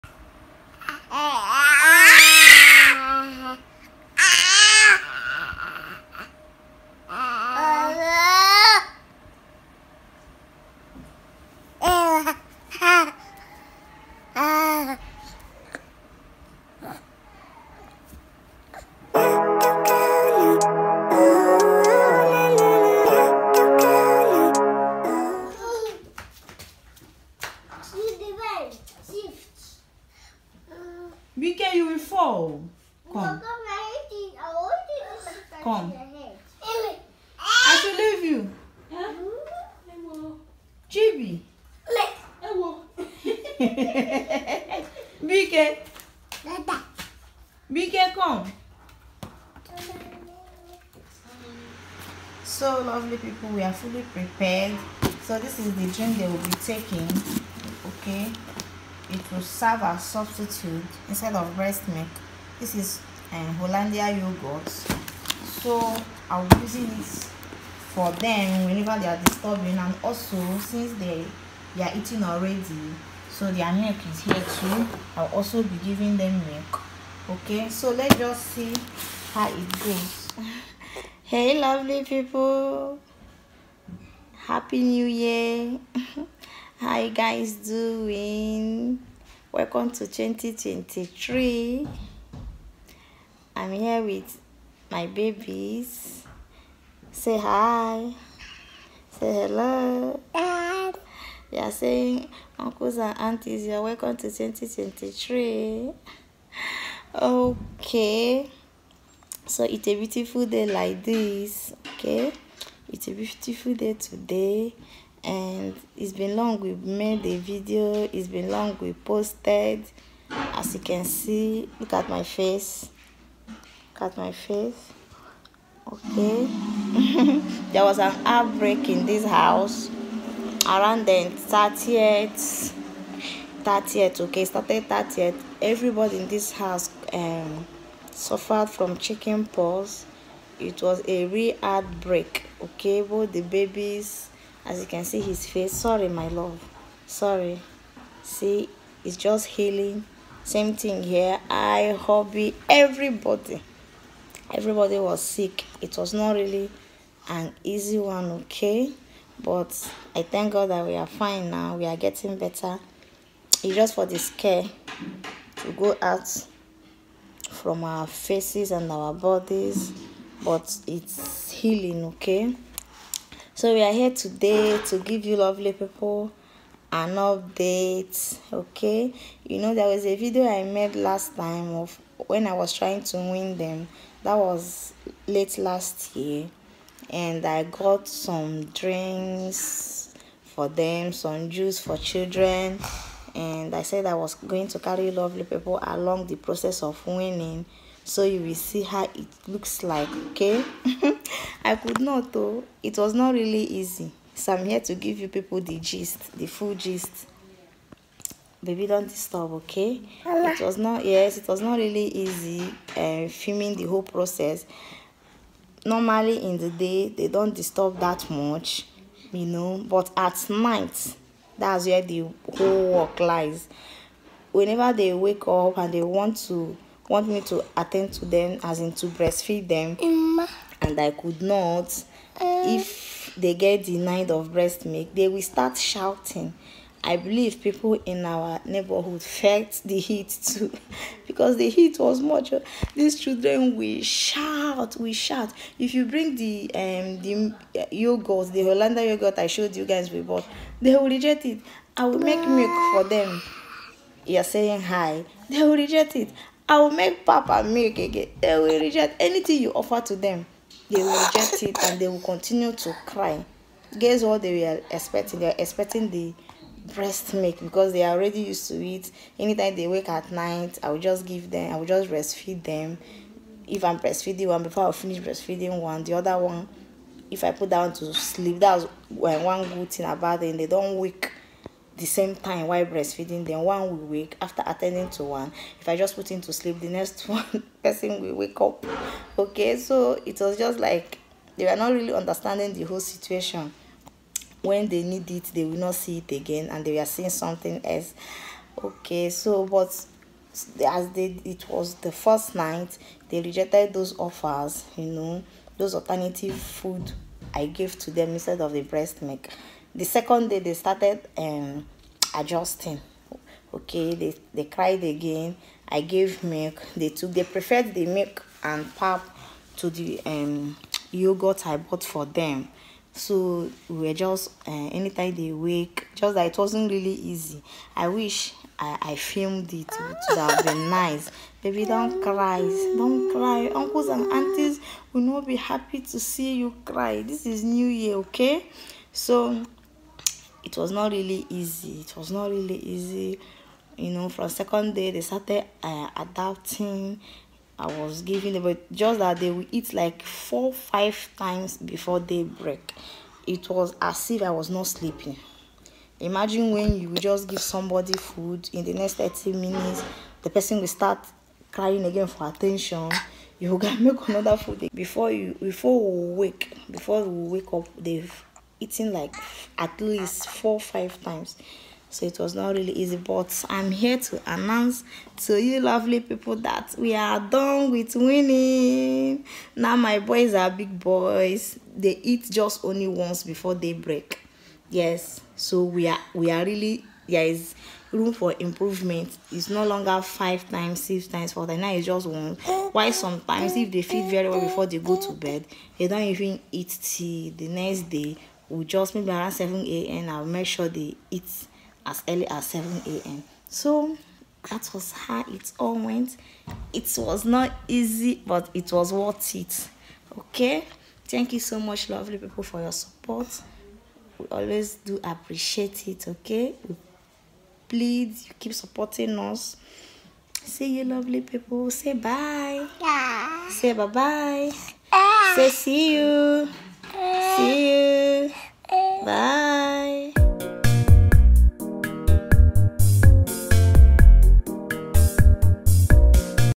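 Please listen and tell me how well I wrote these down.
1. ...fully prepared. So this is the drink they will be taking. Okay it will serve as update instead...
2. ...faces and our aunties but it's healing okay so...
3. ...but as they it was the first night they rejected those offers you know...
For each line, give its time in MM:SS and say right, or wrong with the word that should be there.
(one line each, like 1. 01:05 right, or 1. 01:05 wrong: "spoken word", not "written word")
1. 00:53 wrong: "substitute", not "update"
2. 02:48 wrong: "bodies", not "aunties"
3. 04:59 right.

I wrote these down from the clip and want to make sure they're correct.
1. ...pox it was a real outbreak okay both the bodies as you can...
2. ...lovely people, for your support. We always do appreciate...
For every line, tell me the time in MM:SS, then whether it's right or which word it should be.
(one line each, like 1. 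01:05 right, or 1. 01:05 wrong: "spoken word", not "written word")
1. 02:19 wrong: "babies", not "bodies"
2. 06:52 right.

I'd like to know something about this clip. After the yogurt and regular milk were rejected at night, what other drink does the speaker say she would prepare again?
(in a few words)
papa milk.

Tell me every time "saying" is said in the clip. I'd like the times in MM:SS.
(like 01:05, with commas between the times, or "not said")
01:41, 04:14.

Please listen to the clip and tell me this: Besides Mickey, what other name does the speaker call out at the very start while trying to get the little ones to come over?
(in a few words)
Chibi.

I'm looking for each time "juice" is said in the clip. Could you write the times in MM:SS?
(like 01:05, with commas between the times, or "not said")
03:11.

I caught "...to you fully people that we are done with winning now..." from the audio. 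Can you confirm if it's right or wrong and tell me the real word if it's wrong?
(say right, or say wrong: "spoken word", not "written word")
wrong: "lovely", not "fully".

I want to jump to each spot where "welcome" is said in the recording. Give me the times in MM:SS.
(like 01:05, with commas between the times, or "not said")
01:29, 01:43.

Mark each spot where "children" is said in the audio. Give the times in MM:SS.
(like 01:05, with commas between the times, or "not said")
03:11, 04:03.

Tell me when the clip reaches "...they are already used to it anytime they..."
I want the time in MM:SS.
04:27.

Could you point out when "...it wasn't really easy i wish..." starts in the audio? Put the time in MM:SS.
05:26.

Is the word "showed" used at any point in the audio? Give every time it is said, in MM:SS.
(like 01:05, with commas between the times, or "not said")
04:09.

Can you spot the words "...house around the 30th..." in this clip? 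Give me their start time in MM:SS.
02:09.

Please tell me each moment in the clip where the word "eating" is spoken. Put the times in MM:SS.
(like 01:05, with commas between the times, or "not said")
01:11, 06:08.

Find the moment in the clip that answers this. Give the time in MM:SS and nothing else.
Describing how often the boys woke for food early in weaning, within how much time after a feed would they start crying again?
05:59.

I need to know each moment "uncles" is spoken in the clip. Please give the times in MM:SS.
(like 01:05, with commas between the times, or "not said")
01:42, 05:33.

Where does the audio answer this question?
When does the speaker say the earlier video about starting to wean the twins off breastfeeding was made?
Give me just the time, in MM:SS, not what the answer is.
03:05.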